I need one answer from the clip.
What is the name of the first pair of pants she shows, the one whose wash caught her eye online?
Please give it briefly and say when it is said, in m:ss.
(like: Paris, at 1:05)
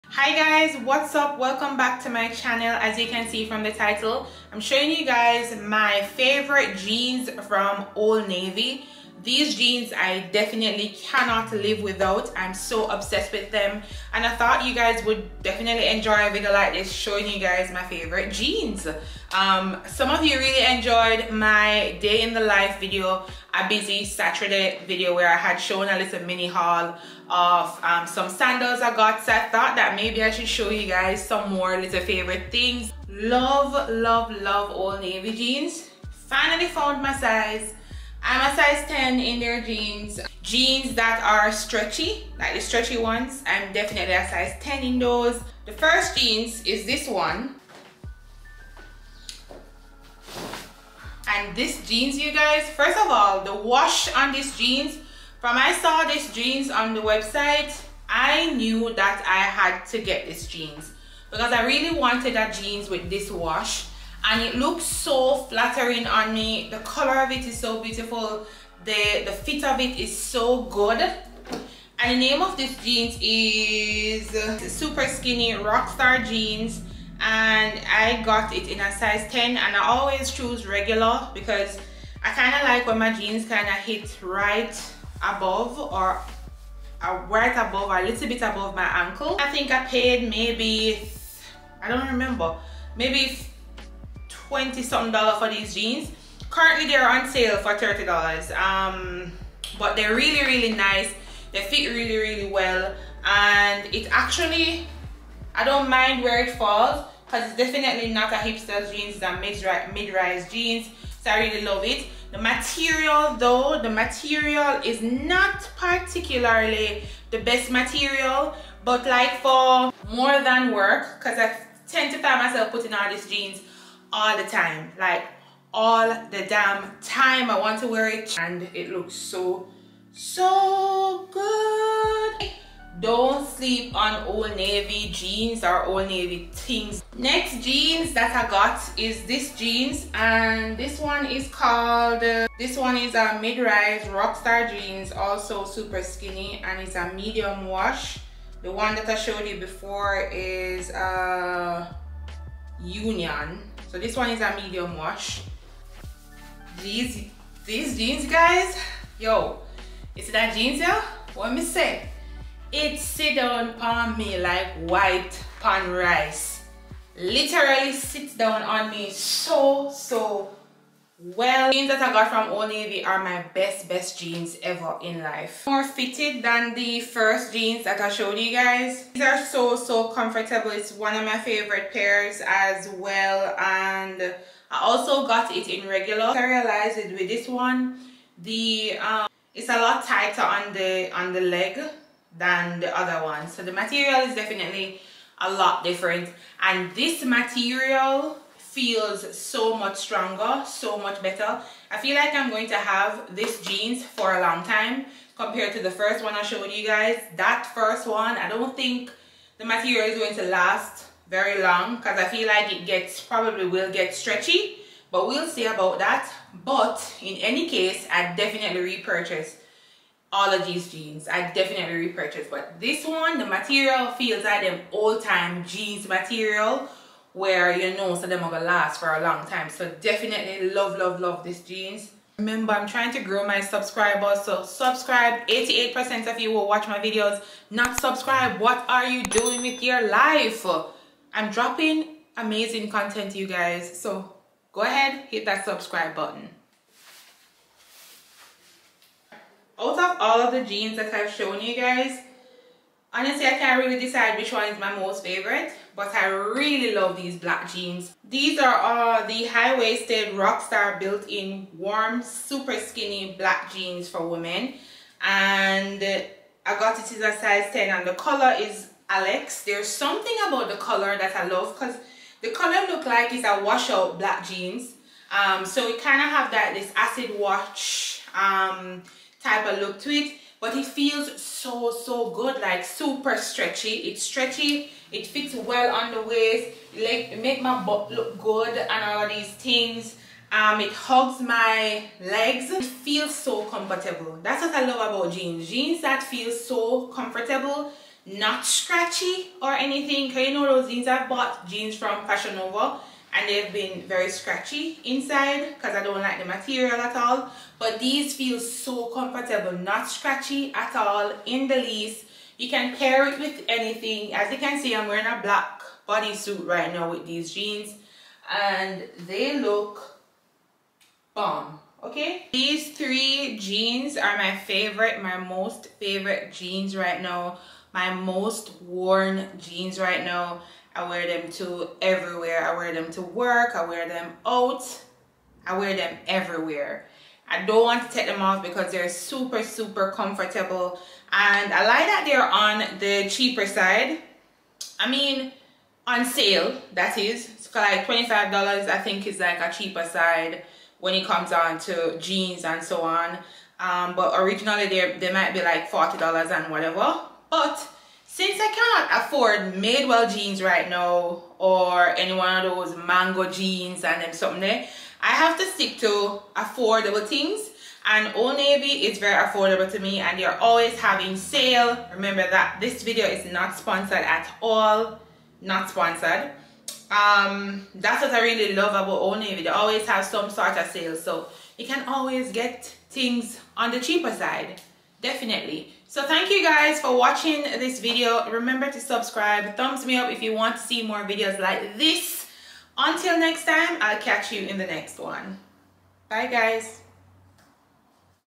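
Super skinny rockstar jeans, at 1:14.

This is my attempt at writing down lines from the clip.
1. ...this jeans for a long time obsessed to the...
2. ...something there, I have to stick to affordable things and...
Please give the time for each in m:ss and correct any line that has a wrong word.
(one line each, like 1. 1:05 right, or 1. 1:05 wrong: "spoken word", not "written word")
1. 3:23 wrong: "compared", not "obsessed"
2. 6:04 right.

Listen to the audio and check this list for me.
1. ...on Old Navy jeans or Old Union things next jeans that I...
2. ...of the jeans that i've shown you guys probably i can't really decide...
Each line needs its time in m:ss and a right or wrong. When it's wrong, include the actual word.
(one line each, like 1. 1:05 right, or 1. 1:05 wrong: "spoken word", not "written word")
1. 2:13 wrong: "Navy", not "Union"
2. 4:10 wrong: "honestly", not "probably".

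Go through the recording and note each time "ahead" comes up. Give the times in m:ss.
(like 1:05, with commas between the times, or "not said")
4:04.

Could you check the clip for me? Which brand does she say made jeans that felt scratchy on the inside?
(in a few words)
Fashion Nova.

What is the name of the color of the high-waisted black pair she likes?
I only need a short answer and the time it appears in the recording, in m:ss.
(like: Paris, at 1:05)
Alex, at 4:29.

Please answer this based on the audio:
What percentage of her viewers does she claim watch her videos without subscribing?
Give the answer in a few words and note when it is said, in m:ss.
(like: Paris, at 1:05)
88 percent, at 3:55.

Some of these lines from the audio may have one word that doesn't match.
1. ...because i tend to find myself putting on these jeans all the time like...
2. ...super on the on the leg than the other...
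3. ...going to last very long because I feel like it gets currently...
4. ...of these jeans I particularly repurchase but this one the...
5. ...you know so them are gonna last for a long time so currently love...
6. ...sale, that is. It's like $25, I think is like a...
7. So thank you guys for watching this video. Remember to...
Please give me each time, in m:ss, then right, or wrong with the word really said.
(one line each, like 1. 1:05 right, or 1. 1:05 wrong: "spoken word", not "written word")
1. 2:01 right
2. 3:10 wrong: "tighter", not "super"
3. 3:30 wrong: "probably", not "currently"
4. 3:40 wrong: "definitely", not "particularly"
5. 3:47 wrong: "definitely", not "currently"
6. 5:46 right
7. 6:26 right.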